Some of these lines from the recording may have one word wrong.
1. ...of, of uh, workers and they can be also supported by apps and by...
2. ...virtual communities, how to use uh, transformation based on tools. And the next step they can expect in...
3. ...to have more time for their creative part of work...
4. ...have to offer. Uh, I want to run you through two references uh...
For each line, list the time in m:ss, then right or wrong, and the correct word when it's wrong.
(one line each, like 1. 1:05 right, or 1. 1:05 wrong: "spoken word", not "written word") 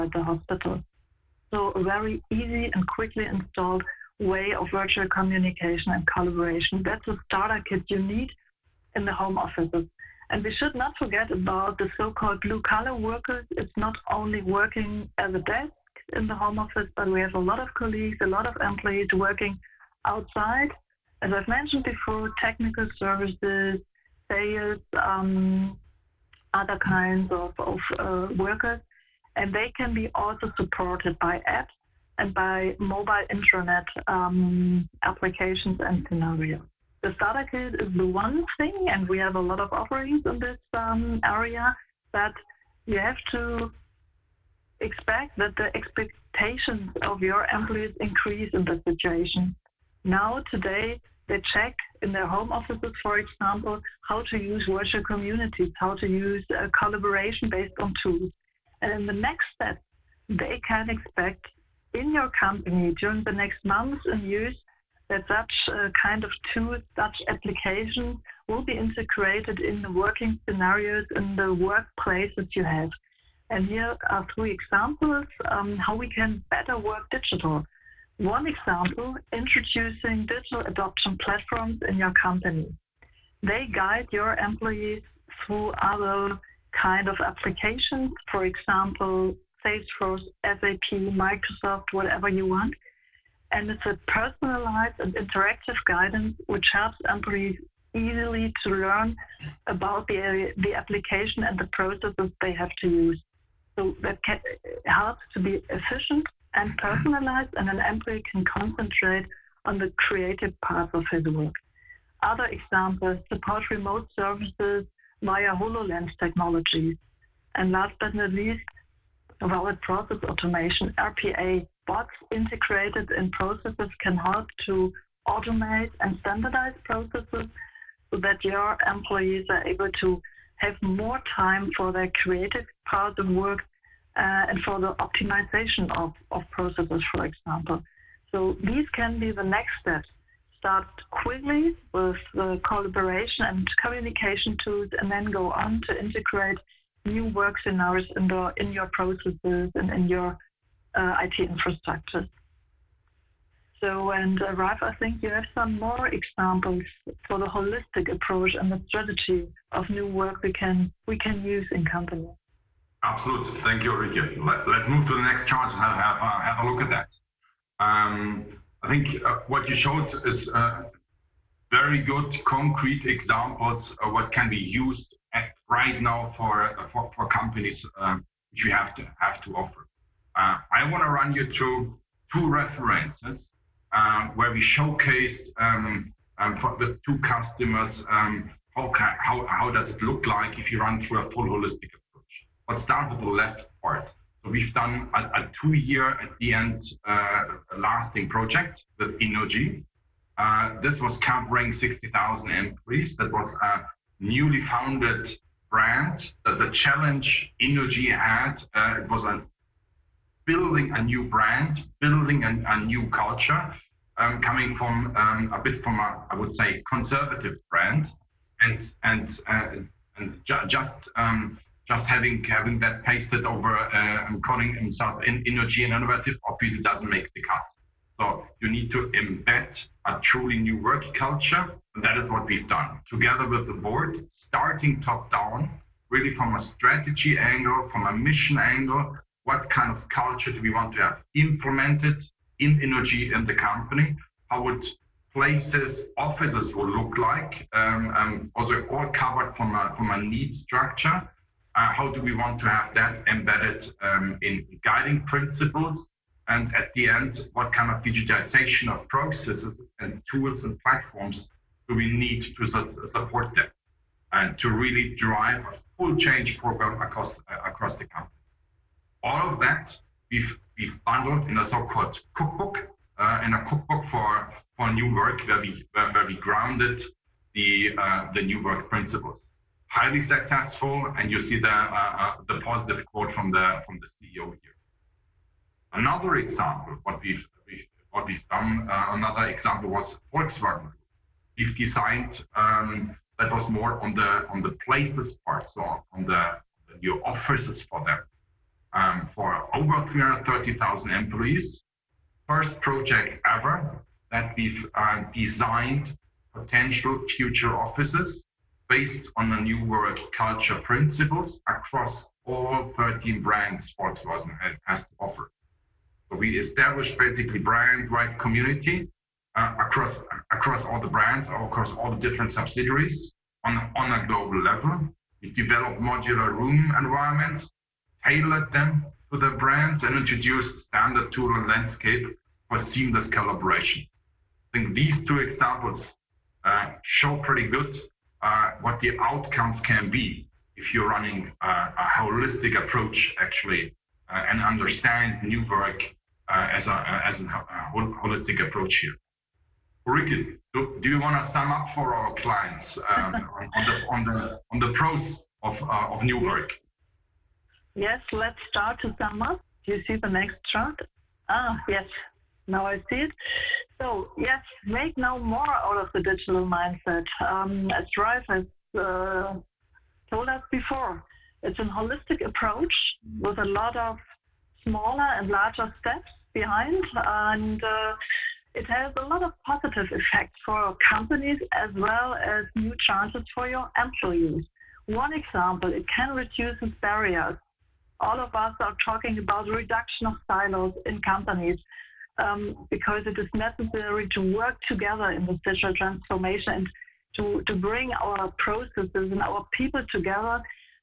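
1. 0:27 right
2. 0:54 wrong: "collaboration", not "transformation"
3. 2:09 right
4. 2:59 right.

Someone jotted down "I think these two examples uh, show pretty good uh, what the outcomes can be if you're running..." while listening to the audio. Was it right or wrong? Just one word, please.
right.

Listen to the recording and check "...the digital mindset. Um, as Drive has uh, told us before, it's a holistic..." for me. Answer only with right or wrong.
right.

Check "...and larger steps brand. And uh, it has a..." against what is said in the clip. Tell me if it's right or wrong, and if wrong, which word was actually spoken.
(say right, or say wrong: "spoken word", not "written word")
wrong: "behind", not "brand".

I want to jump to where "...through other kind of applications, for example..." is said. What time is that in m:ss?
1:25.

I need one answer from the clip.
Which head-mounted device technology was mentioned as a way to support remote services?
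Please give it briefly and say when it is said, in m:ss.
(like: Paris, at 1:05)
HoloLens, at 1:55.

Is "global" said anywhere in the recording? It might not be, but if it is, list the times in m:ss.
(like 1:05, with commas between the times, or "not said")
5:24.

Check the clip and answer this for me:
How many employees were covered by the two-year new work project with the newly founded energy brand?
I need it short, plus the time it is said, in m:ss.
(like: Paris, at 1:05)
60,000, at 3:21.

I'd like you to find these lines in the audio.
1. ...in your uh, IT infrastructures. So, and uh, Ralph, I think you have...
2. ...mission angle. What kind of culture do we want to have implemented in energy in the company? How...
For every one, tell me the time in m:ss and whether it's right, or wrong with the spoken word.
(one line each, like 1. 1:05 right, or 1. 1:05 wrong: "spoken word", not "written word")
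1. 2:29 right
2. 3:58 right.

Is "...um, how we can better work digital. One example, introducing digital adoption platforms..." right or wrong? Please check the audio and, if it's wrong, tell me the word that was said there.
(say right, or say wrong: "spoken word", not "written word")
right.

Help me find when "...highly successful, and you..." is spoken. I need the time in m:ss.
4:39.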